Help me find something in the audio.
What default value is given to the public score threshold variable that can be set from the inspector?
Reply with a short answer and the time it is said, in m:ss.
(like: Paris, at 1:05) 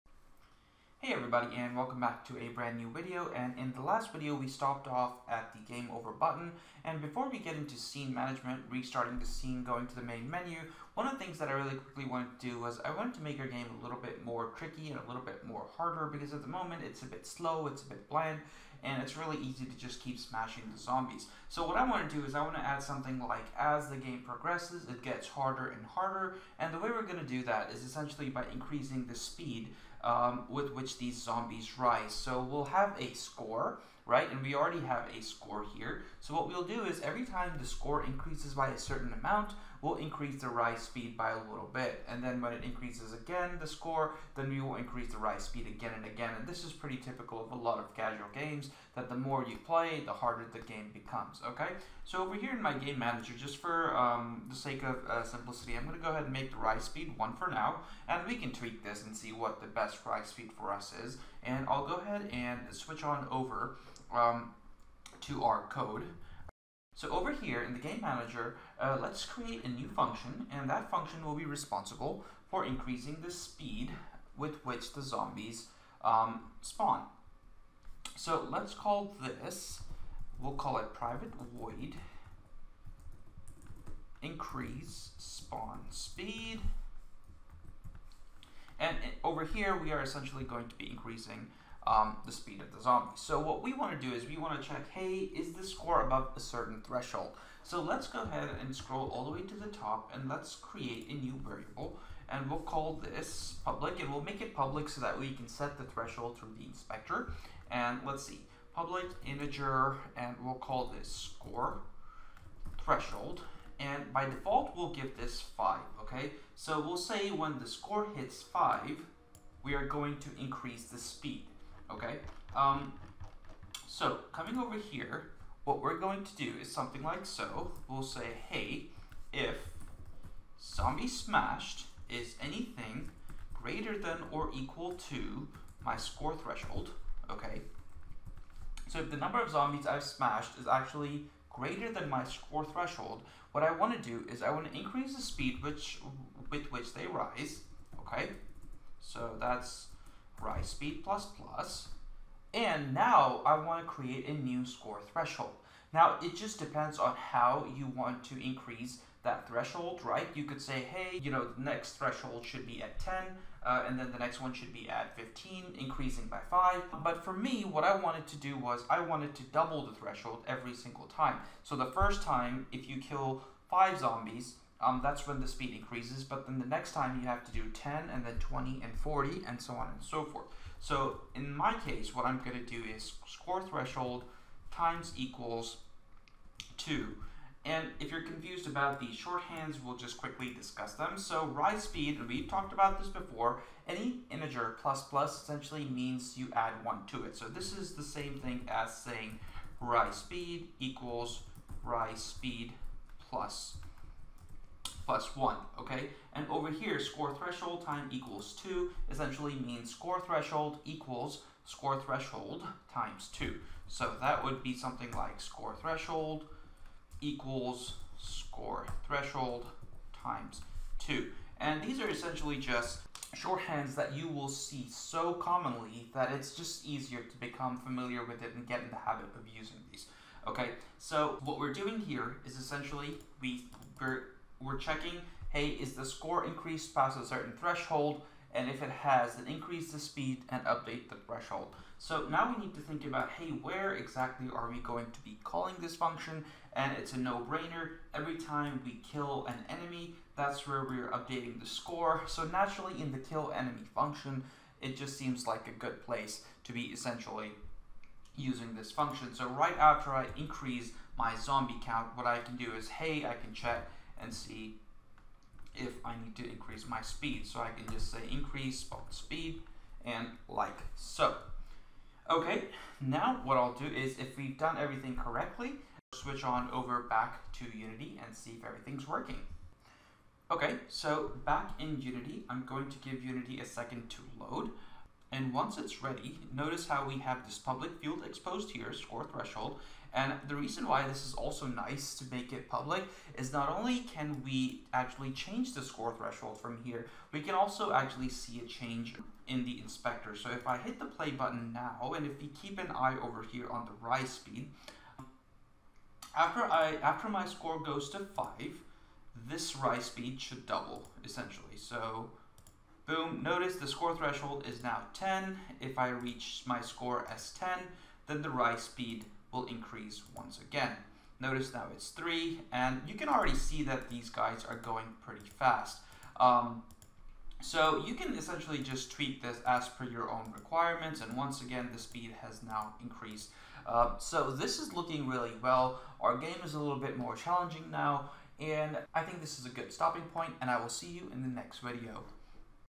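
5, at 1:54.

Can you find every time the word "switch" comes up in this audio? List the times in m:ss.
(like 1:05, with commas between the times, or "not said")
1:02, 4:36.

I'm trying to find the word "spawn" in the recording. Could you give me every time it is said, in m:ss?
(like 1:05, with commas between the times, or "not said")
1:16, 1:25, 4:28.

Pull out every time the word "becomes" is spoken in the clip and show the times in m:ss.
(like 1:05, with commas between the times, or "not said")
0:50, 3:47.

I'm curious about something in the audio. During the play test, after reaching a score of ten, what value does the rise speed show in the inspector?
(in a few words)
3.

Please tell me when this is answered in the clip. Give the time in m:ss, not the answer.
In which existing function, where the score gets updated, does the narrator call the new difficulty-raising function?
4:13.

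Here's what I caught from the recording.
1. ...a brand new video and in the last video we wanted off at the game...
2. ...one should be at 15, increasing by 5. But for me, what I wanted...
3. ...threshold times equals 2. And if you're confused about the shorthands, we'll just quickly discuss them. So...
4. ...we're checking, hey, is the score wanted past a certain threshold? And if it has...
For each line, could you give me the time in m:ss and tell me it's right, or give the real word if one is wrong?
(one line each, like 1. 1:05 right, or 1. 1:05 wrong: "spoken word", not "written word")
1. 0:02 wrong: "stopped", not "wanted"
2. 2:44 right
3. 3:03 right
4. 3:54 wrong: "increased", not "wanted".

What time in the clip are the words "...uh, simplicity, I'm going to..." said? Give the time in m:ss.
0:55.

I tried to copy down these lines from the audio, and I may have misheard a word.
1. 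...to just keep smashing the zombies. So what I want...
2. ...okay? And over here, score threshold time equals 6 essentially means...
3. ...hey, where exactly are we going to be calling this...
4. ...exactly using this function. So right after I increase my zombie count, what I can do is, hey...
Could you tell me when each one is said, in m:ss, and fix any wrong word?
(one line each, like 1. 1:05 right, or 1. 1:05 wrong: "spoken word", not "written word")
1. 0:19 right
2. 3:25 wrong: "2", not "6"
3. 4:03 right
4. 4:16 wrong: "essentially", not "exactly".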